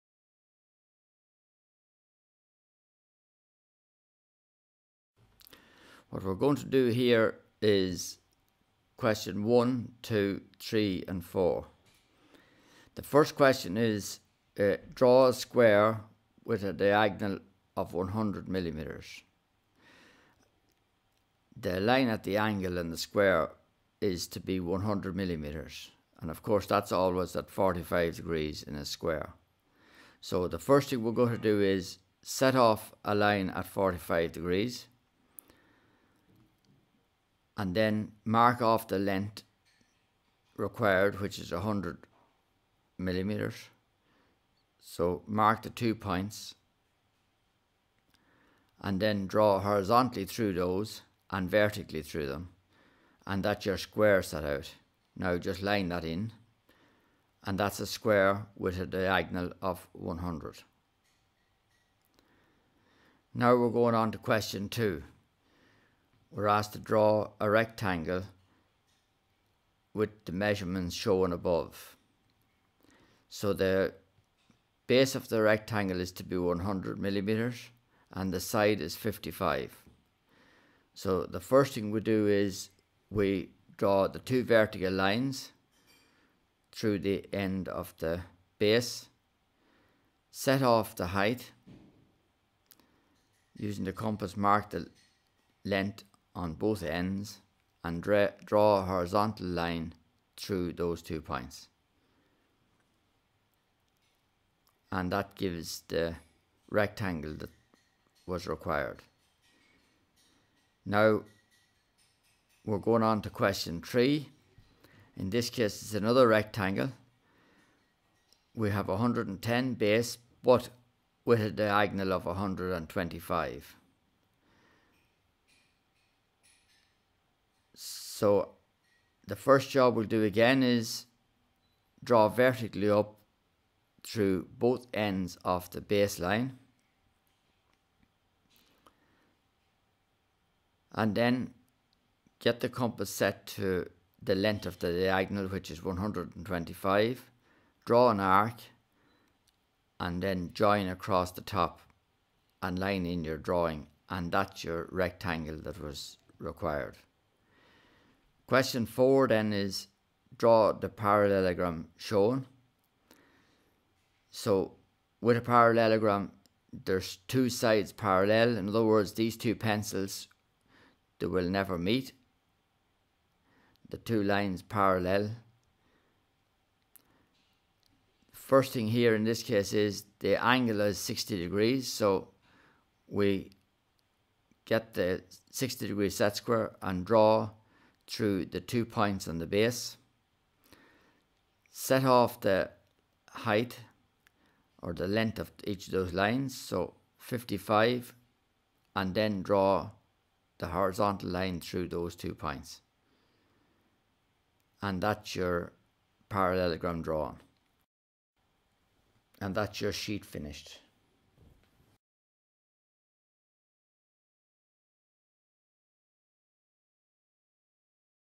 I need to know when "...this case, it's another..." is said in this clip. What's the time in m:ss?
1:55.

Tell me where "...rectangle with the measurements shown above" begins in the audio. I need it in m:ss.
1:07.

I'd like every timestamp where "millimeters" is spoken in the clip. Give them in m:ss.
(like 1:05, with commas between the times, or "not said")
0:18, 0:25, 0:42, 1:16.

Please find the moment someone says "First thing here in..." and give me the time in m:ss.
2:58.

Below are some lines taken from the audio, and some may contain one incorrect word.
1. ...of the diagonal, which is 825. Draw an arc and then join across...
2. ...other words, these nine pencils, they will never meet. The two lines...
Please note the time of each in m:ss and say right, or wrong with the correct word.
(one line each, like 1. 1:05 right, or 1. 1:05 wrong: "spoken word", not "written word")
1. 2:24 wrong: "125", not "825"
2. 2:48 wrong: "two", not "nine".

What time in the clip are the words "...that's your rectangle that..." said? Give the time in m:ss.
2:34.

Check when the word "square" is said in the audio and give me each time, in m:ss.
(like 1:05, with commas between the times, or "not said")
0:15, 0:22, 0:28, 0:53, 0:57, 3:06.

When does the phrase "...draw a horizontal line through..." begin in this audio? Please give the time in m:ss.
1:38.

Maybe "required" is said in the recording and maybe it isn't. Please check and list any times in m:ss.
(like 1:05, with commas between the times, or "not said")
0:40, 1:48, 2:36.